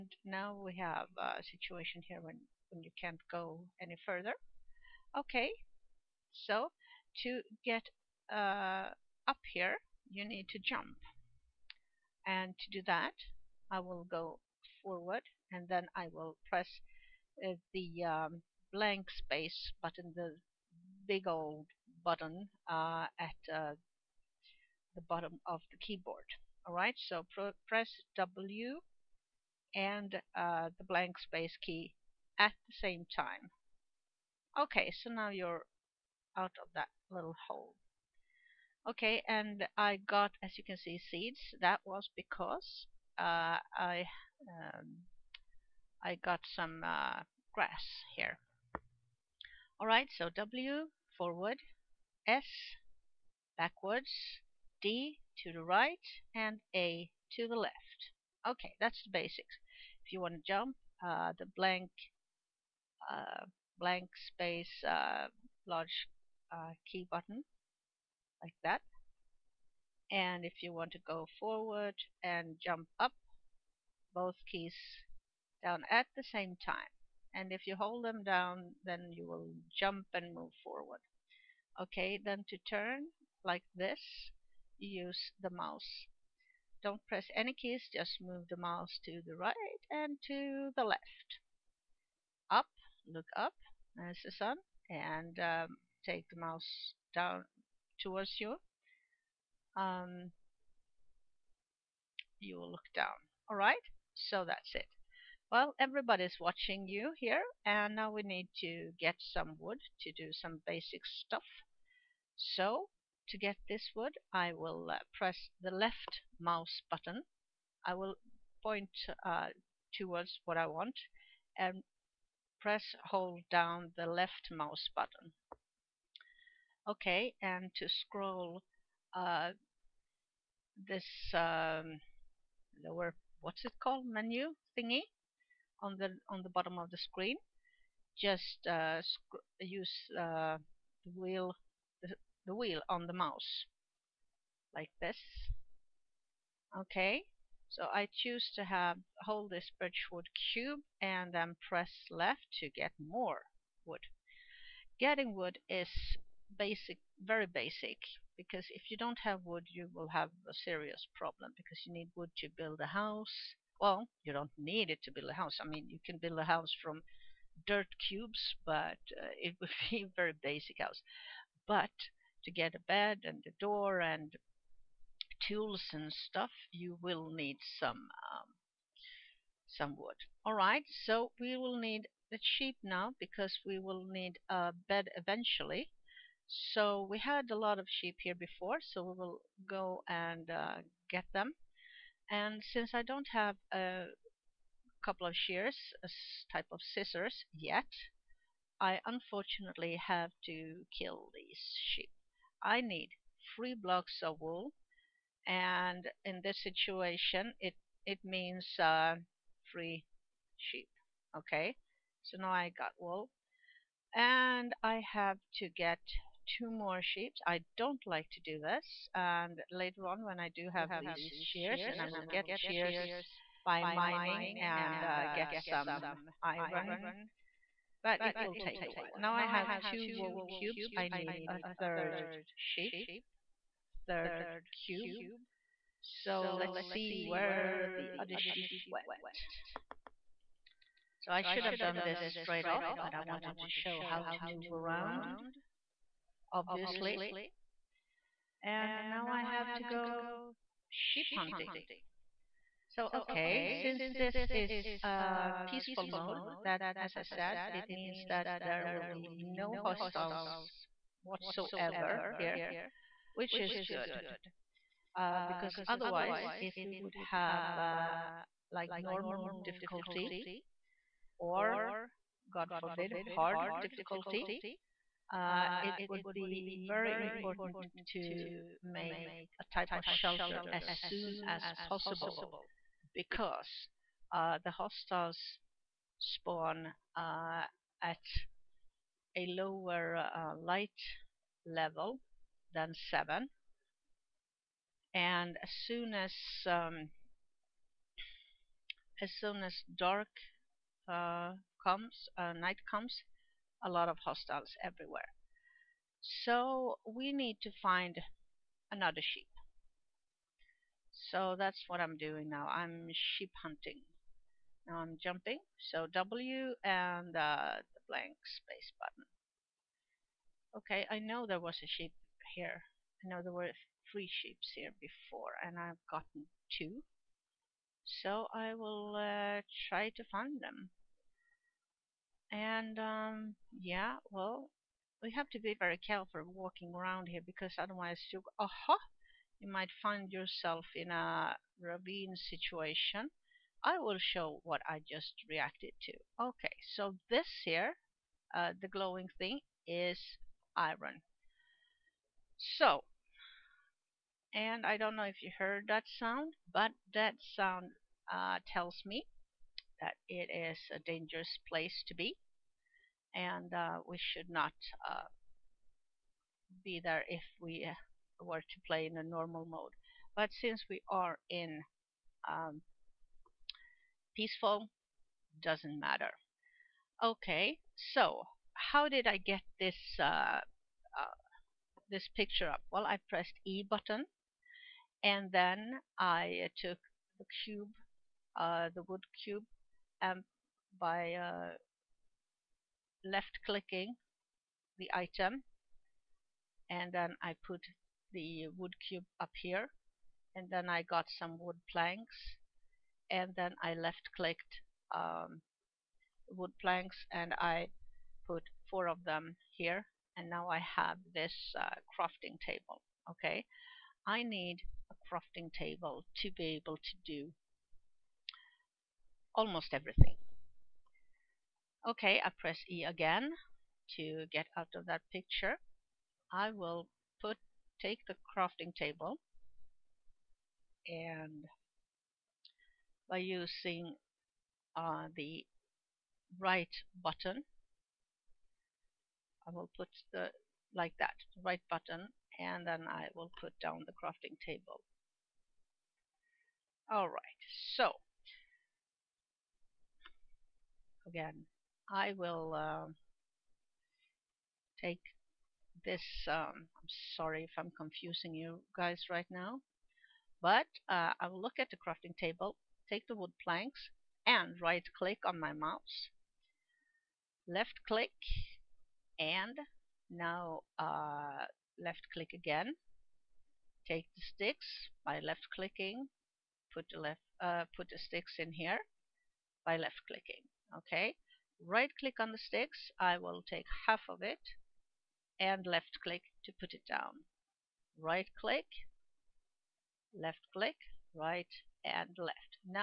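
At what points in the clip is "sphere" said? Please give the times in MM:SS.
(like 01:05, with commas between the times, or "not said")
not said.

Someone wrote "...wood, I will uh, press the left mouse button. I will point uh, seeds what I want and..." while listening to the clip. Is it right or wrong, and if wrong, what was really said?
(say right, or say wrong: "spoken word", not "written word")
wrong: "towards", not "seeds".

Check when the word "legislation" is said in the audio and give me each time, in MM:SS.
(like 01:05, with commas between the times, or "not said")
not said.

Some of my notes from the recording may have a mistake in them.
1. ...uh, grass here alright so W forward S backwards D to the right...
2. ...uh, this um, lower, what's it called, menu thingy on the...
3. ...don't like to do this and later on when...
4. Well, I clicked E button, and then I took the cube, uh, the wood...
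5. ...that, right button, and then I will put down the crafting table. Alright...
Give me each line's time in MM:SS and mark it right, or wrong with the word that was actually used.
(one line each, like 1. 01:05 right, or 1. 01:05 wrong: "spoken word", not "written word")
1. 00:46 right
2. 02:09 right
3. 03:37 right
4. 06:22 wrong: "pressed", not "clicked"
5. 07:21 right.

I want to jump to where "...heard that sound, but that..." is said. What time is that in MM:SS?
05:55.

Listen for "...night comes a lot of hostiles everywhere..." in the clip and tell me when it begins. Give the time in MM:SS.
05:02.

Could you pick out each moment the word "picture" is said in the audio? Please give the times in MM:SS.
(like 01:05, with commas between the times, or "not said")
06:22, 07:05.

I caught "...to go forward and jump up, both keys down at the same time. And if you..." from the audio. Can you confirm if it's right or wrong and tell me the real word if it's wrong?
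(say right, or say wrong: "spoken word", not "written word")
right.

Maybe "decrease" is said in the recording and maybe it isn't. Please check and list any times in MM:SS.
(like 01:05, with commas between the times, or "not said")
not said.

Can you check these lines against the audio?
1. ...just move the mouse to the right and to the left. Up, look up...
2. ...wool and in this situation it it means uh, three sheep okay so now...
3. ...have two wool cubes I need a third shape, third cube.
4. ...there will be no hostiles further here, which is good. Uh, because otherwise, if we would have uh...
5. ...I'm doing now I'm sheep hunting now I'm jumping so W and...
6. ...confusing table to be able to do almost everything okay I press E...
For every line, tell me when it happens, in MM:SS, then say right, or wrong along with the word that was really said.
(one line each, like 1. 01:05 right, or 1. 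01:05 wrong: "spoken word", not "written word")
1. 01:27 right
2. 03:24 right
3. 03:49 right
4. 04:18 wrong: "whatsoever", not "further"
5. 05:11 right
6. 06:55 wrong: "crafting", not "confusing".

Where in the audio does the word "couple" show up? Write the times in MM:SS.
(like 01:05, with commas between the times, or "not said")
03:15.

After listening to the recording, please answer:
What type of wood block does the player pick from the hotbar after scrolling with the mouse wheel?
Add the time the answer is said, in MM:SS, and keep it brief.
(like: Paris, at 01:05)
Birchwood, at 02:29.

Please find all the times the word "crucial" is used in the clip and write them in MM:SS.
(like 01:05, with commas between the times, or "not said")
not said.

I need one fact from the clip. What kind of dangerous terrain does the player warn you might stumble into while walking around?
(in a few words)
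A ravine.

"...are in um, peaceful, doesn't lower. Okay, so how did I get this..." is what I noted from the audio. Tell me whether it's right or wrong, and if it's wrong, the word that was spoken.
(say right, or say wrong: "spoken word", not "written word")
wrong: "matter", not "lower".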